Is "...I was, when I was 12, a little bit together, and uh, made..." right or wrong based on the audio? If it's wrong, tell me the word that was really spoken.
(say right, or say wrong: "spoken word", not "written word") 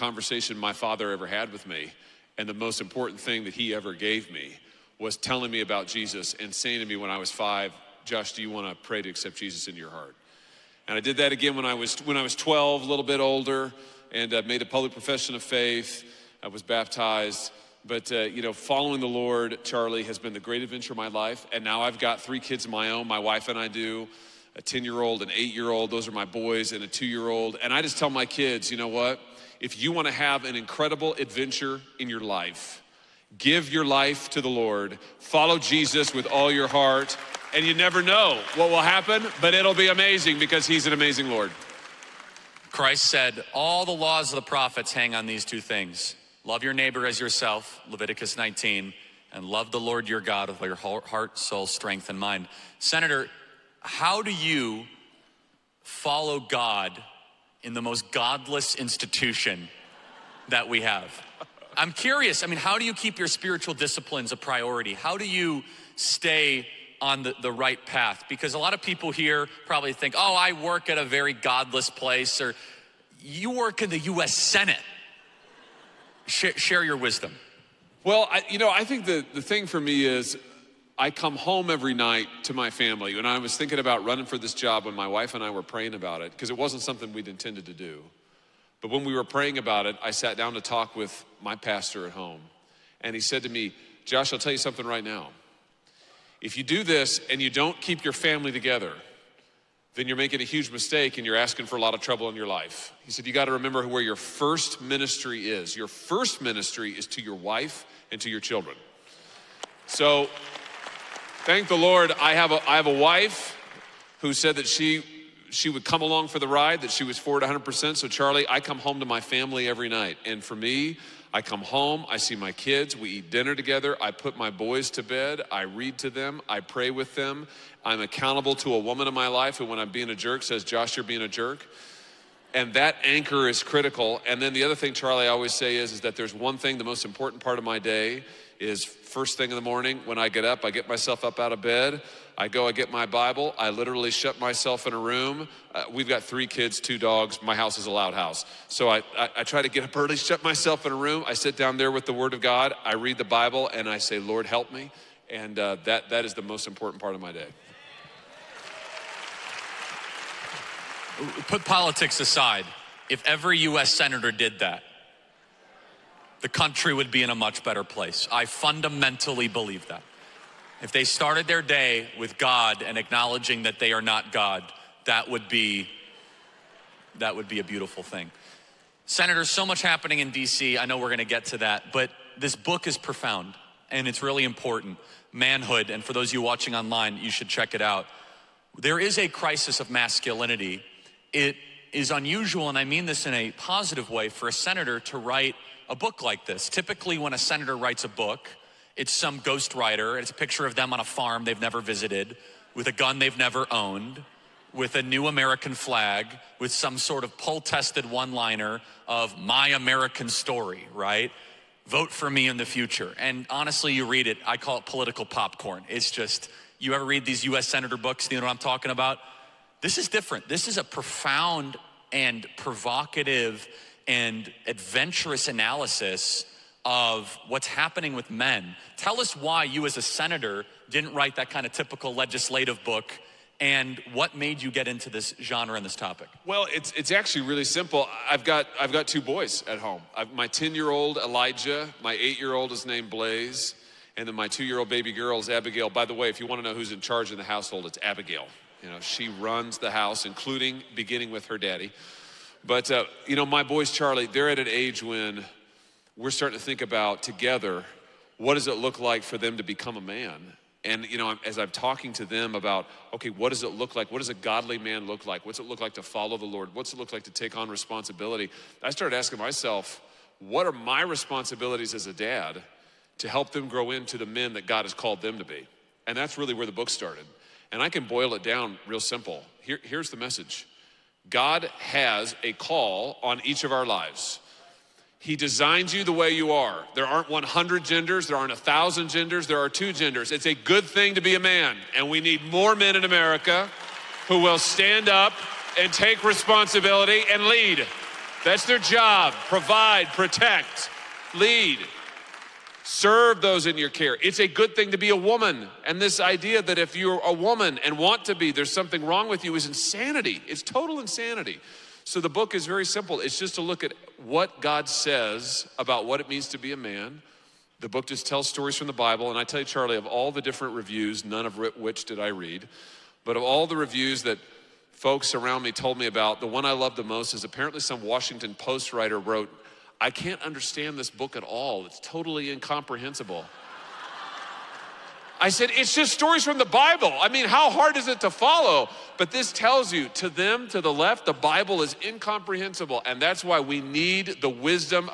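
wrong: "older", not "together".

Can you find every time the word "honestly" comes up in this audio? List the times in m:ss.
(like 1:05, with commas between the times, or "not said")
3:33.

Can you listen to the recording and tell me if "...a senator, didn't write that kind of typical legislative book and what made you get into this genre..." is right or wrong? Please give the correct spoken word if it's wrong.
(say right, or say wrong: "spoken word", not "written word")
right.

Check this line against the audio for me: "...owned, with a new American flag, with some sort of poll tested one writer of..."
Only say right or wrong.
wrong.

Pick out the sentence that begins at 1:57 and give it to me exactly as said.
So, Charlie, I come home to my family every night.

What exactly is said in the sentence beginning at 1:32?
And he said to me, Josh, I'll tell you something right now.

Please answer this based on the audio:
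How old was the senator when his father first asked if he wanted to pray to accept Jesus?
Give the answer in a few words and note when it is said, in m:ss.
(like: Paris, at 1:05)
5, at 0:07.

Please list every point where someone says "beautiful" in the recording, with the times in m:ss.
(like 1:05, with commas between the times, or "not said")
2:57.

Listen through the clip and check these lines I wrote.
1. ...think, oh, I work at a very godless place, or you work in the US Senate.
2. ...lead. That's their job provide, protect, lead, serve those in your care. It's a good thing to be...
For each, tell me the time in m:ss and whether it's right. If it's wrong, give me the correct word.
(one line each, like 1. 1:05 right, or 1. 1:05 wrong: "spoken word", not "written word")
1. 1:09 right
2. 4:57 right.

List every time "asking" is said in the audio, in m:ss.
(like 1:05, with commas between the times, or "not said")
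1:41, 4:29.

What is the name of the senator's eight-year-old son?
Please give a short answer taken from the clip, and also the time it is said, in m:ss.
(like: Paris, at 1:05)
Blaze, at 4:03.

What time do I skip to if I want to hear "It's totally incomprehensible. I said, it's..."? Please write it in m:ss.
5:31.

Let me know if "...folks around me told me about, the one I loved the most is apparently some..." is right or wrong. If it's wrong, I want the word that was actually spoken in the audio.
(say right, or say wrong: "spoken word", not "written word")
right.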